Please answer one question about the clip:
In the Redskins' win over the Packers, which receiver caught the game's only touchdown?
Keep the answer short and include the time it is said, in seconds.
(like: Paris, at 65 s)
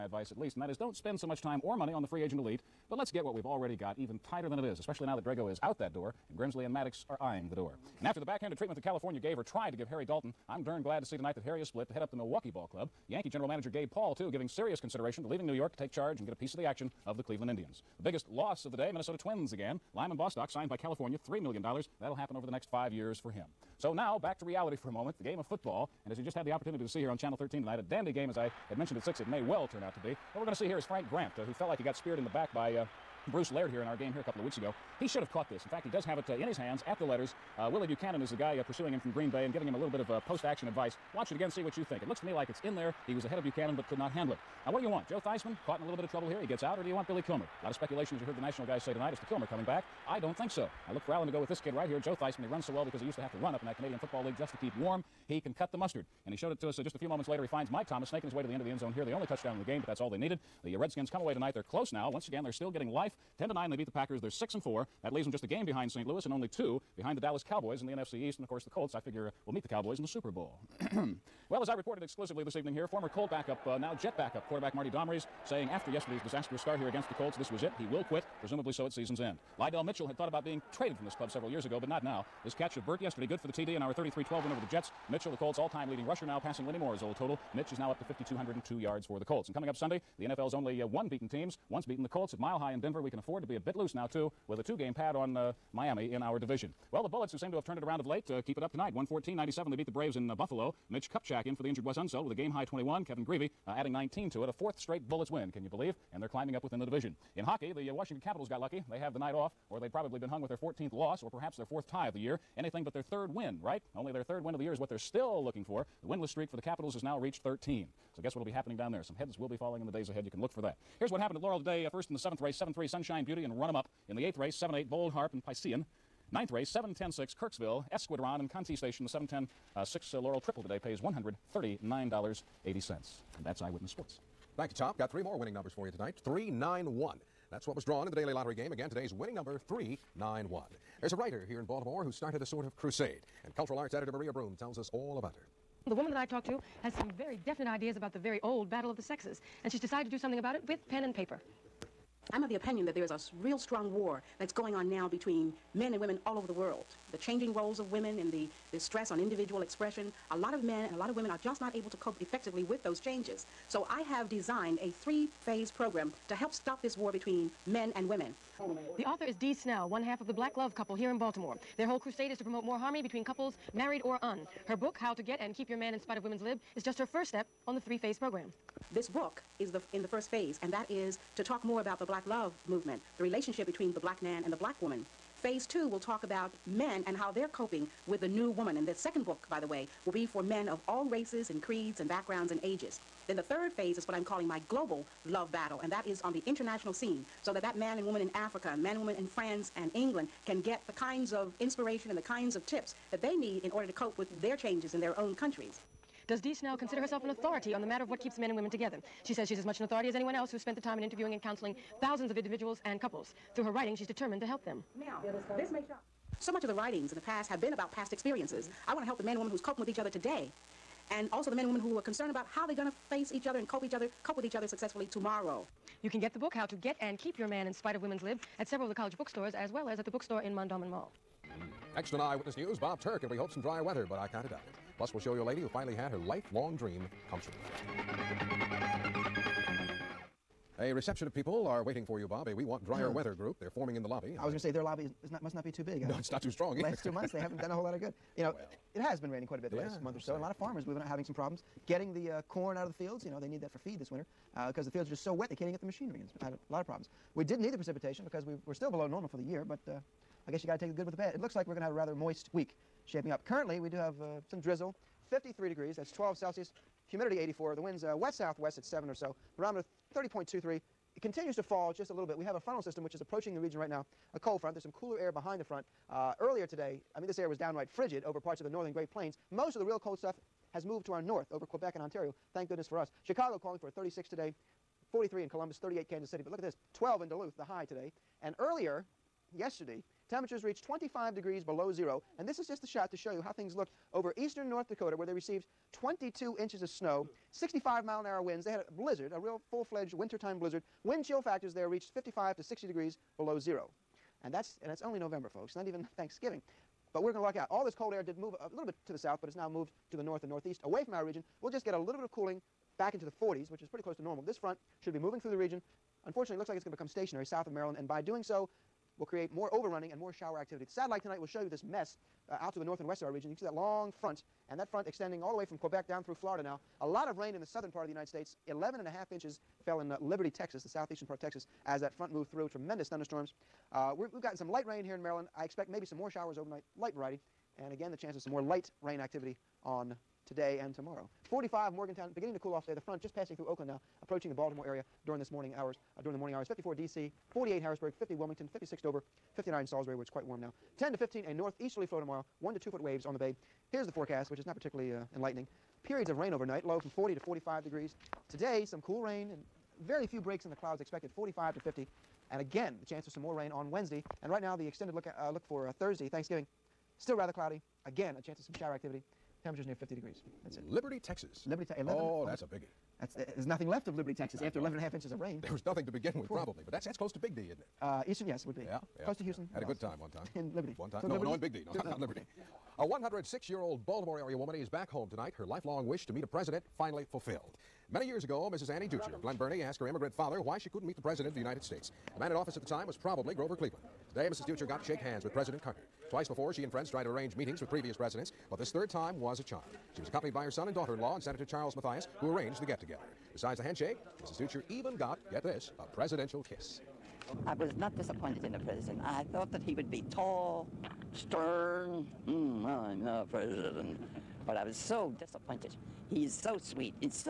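Mike Thomas, at 57 s.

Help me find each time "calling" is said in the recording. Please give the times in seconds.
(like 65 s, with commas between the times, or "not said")
194 s, 283 s.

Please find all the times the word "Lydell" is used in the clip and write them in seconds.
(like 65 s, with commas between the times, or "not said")
79 s.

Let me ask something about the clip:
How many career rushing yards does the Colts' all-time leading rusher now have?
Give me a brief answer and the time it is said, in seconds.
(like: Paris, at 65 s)
5,202, at 88 s.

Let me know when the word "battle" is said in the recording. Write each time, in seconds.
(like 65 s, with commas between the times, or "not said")
148 s, 195 s.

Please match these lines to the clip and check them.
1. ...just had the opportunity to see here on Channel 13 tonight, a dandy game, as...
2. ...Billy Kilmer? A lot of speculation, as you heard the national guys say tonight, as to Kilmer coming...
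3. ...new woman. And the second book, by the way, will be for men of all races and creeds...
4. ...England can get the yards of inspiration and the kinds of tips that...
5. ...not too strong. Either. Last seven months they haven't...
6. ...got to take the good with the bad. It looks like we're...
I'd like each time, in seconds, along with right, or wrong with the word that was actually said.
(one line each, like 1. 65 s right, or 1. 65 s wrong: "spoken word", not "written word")
1. 26 s right
2. 47 s right
3. 188 s right
4. 199 s wrong: "kinds", not "yards"
5. 246 s wrong: "two", not "seven"
6. 260 s right.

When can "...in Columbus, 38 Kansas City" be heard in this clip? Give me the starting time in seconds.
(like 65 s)
285 s.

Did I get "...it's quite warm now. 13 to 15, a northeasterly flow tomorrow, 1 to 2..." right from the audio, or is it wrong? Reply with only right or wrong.
wrong.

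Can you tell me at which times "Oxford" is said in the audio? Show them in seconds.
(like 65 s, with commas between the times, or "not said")
not said.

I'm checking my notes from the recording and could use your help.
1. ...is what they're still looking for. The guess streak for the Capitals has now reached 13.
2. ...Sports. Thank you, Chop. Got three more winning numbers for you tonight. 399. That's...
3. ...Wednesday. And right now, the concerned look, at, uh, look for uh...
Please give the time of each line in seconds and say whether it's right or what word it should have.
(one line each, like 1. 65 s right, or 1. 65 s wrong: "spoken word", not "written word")
1. 114 s wrong: "winless", not "guess"
2. 133 s wrong: "391", not "399"
3. 363 s wrong: "extended", not "concerned".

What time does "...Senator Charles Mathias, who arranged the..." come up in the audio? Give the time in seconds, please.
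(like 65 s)
401 s.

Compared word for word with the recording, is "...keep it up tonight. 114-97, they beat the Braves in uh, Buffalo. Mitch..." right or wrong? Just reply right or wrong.
right.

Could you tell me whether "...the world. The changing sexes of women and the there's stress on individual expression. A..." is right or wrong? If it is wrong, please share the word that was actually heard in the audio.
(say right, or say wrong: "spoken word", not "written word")
wrong: "roles", not "sexes".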